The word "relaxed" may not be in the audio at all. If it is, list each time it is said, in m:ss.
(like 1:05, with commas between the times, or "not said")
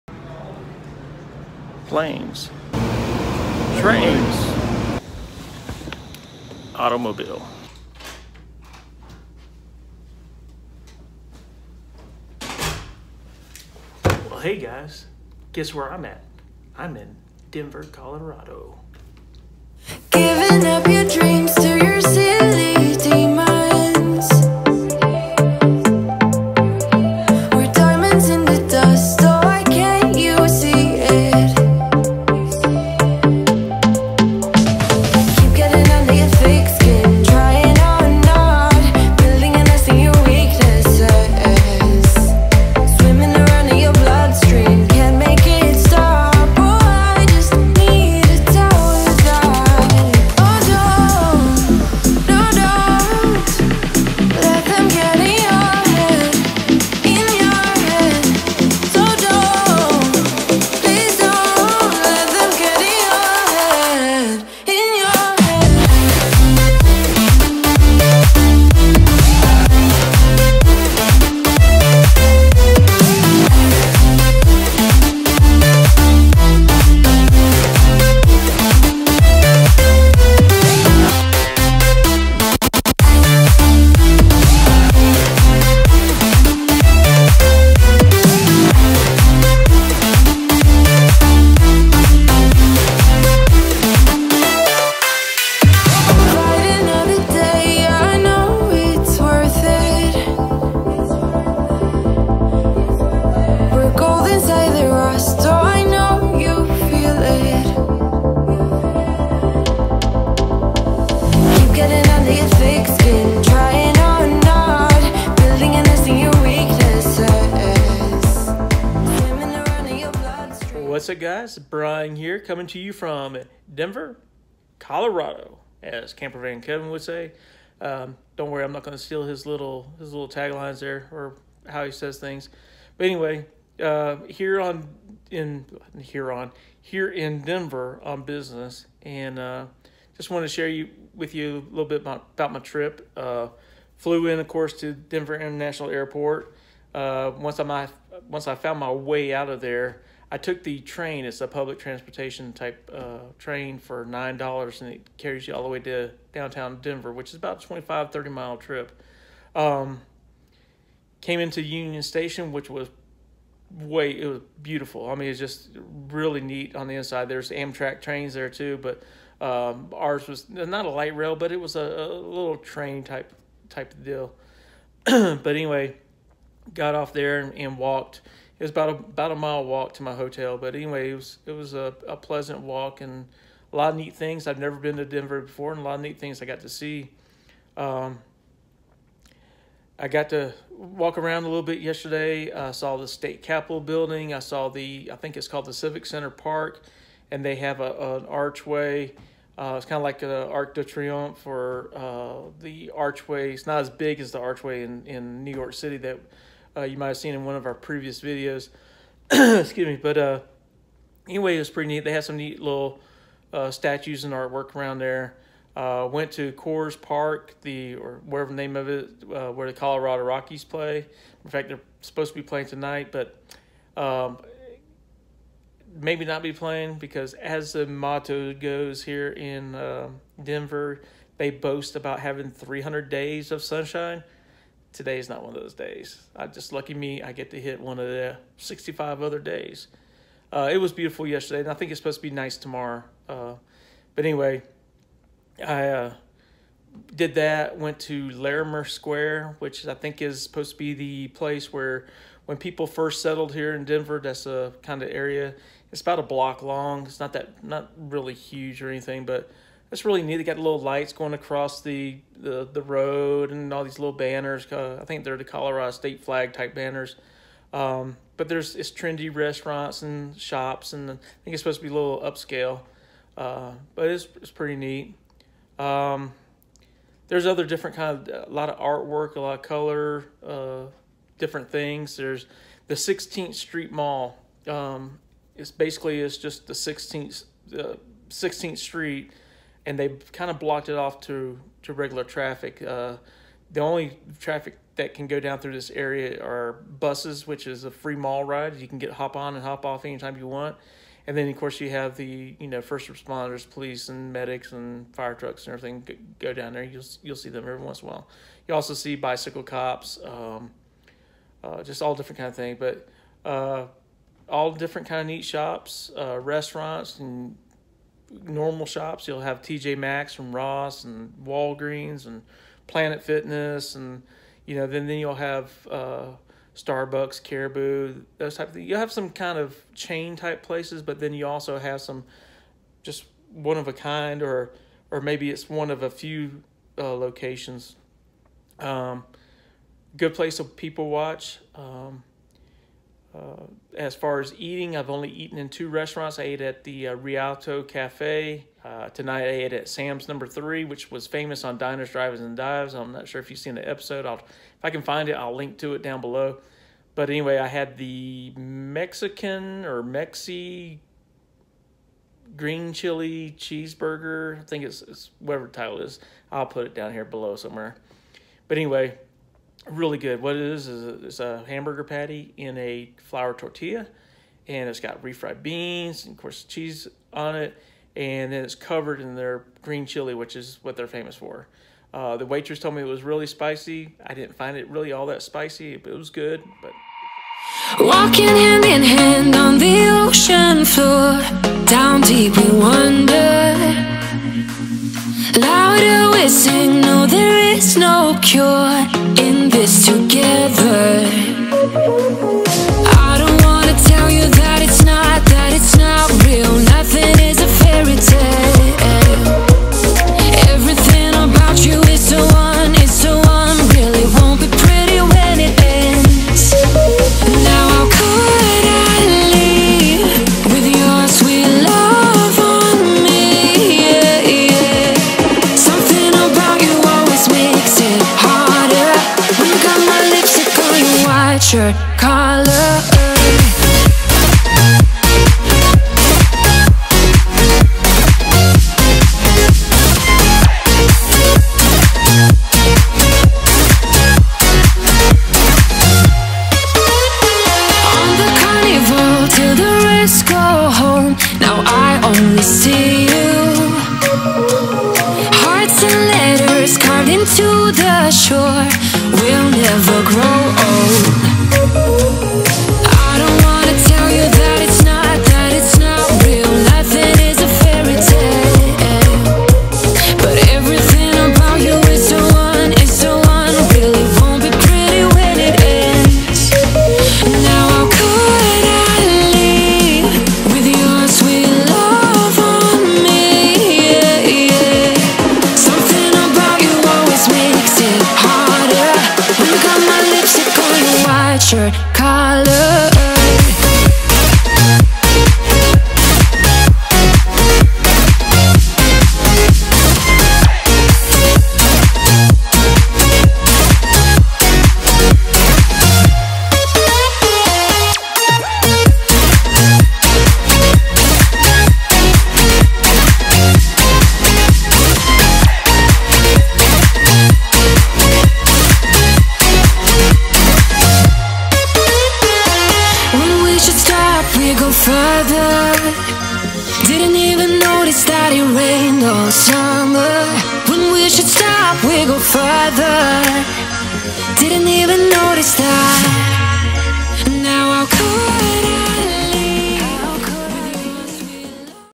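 not said.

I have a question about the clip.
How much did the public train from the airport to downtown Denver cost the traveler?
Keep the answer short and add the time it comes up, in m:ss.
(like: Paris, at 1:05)
$9, at 2:34.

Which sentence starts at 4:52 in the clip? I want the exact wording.
Uh, the only traffic that can go down through this area are buses, which is a free mall ride.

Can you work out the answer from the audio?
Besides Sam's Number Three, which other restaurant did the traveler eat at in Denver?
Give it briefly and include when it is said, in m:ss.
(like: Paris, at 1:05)
Rialto Cafe, at 5:47.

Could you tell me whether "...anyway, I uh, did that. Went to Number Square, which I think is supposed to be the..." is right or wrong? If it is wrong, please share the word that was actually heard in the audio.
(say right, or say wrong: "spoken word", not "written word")
wrong: "Larimer", not "Number".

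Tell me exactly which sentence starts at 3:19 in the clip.
Uh, it's kind of like the Arc de Triomphe for uh, the archway.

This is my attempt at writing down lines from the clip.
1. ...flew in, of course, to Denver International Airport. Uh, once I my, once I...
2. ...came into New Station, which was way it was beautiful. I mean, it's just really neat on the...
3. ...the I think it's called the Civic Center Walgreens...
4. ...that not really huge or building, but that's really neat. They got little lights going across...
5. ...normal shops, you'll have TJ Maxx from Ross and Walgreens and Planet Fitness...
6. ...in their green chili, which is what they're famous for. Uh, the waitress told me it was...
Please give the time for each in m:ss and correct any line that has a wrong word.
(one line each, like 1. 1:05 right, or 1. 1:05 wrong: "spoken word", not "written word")
1. 2:23 right
2. 2:41 wrong: "Union", not "New"
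3. 3:14 wrong: "Park", not "Walgreens"
4. 4:17 wrong: "anything", not "building"
5. 5:18 right
6. 6:19 right.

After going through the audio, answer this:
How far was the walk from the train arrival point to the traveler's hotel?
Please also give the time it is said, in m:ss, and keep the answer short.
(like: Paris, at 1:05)
about a mile, at 2:58.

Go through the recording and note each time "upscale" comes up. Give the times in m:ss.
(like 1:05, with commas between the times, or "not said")
4:32.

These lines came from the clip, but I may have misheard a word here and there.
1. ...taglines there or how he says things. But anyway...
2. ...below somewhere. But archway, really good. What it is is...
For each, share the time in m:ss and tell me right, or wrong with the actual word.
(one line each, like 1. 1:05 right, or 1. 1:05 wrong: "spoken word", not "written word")
1. 2:10 right
2. 6:07 wrong: "anyway", not "archway".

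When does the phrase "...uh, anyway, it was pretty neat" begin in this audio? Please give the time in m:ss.
3:30.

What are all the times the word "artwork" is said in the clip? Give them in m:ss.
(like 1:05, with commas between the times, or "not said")
3:34, 4:38.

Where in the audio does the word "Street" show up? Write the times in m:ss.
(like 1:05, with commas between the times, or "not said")
4:43, 4:48.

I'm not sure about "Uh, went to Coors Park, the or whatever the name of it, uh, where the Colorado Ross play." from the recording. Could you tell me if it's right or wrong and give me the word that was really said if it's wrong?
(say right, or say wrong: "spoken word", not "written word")
wrong: "Rockies", not "Ross".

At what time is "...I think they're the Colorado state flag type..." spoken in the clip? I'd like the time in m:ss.
4:25.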